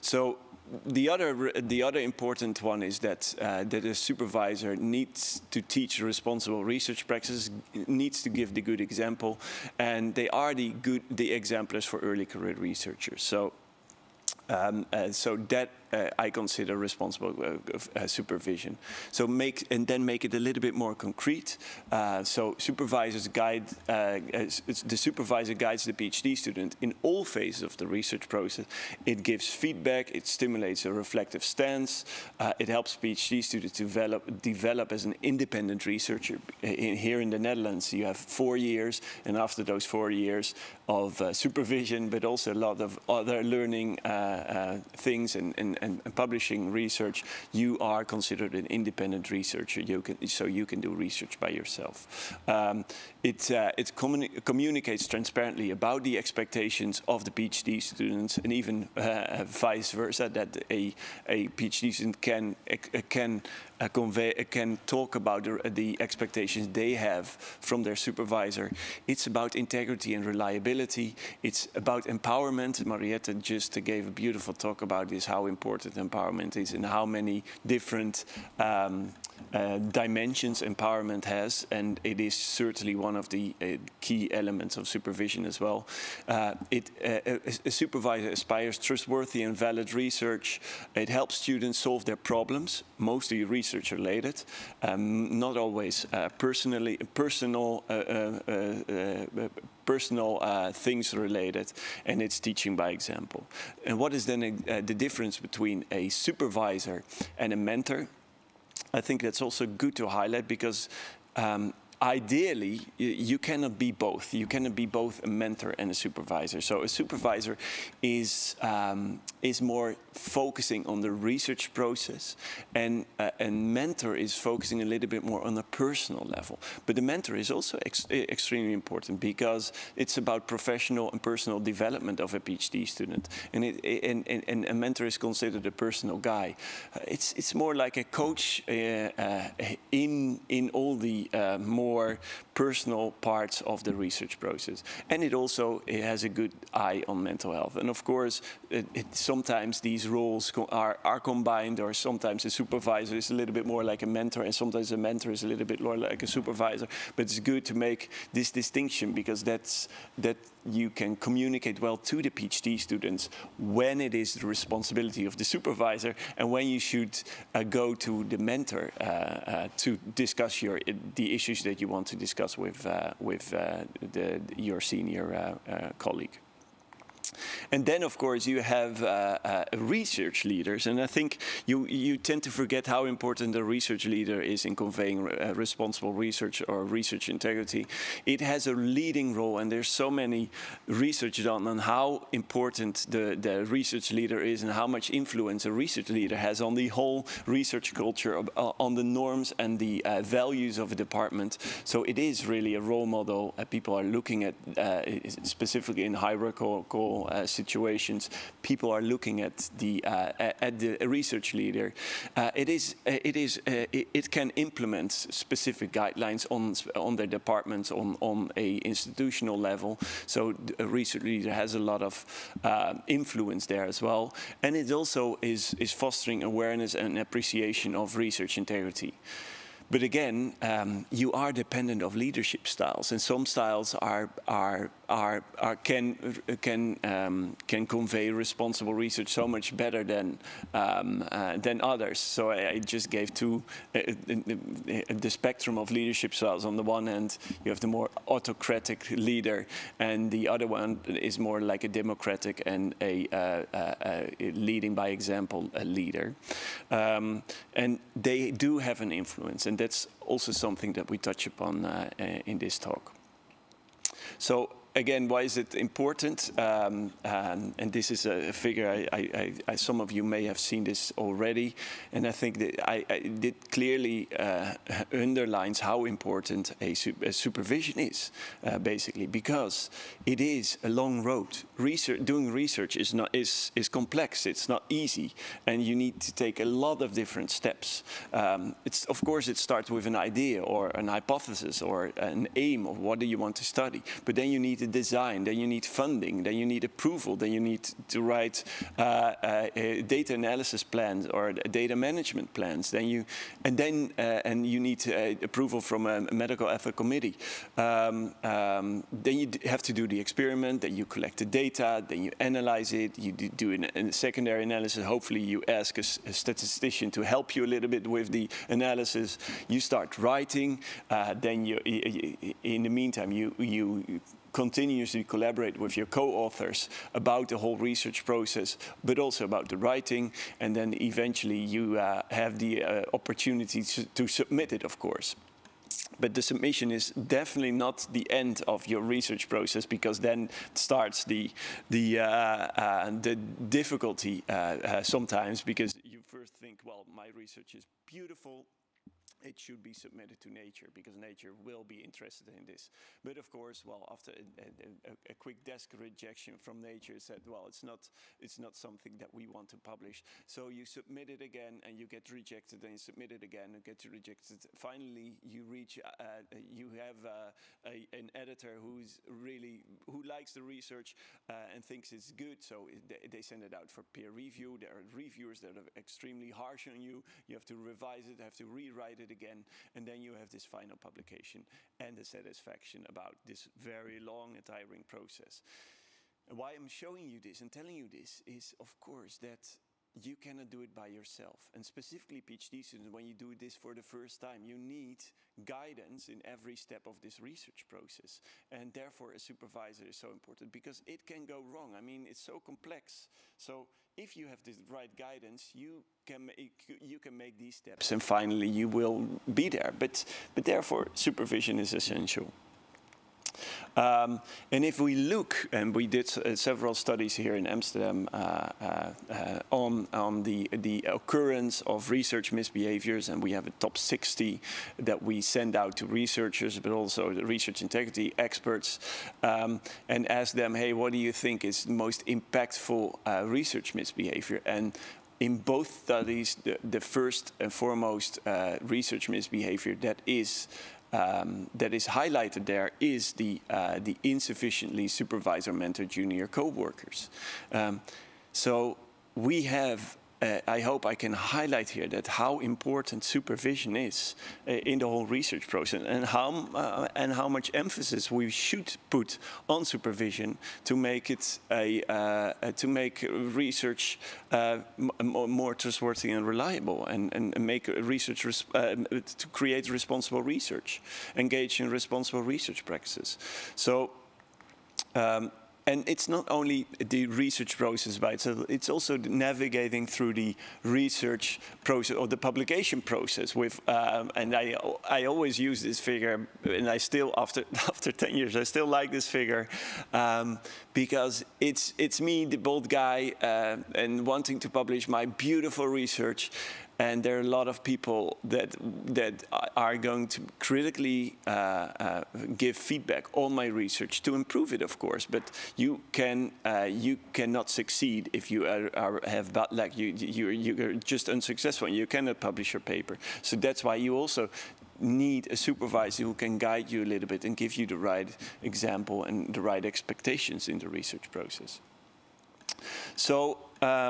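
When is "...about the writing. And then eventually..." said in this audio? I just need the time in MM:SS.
05:29.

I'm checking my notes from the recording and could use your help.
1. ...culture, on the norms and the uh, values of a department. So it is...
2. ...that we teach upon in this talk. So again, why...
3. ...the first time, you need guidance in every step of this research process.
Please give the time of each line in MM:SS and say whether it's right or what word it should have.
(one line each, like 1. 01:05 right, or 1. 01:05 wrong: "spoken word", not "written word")
1. 03:17 right
2. 04:20 wrong: "touch", not "teach"
3. 06:33 right.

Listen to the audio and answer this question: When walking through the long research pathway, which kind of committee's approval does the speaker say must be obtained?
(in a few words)
medical ethics committee.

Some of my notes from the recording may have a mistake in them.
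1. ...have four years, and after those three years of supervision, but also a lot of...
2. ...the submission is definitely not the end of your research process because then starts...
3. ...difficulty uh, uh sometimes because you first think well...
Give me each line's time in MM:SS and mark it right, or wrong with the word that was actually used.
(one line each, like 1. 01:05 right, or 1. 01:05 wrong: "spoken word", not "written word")
1. 00:38 wrong: "four", not "three"
2. 05:36 right
3. 05:43 right.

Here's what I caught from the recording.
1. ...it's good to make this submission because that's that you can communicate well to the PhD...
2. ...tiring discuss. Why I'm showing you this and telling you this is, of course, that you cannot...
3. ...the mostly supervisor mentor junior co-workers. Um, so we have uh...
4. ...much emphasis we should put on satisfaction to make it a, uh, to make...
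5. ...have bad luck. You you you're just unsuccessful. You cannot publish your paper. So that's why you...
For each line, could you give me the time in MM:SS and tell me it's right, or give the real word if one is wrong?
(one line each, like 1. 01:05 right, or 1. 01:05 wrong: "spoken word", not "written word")
1. 02:37 wrong: "distinction", not "submission"
2. 06:24 wrong: "process", not "discuss"
3. 07:24 wrong: "insufficiently", not "mostly"
4. 07:37 wrong: "supervision", not "satisfaction"
5. 08:29 right.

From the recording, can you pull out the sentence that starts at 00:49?
You can, so you can do research by yourself.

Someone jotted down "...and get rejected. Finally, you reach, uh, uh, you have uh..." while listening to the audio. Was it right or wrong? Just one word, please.
right.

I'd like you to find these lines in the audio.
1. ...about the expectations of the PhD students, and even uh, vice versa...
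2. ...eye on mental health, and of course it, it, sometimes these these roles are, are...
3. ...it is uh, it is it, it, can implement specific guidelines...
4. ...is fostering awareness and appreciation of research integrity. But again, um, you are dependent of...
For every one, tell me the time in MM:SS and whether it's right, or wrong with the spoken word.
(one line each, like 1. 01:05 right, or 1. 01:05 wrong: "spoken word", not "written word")
1. 00:55 right
2. 02:26 right
3. 03:32 right
4. 03:45 right.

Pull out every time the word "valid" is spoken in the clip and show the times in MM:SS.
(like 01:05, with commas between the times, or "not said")
01:29.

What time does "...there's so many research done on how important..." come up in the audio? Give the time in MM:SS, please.
03:09.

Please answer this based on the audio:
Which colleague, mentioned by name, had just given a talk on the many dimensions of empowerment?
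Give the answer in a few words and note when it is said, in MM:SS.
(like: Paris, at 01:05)
Marietta, at 01:12.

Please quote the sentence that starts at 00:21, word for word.
Uh, so supervisors guide uh, the supervisor guides the PhD student in all phases of the research process.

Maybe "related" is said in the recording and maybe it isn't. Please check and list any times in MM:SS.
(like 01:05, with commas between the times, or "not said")
01:33, 01:41.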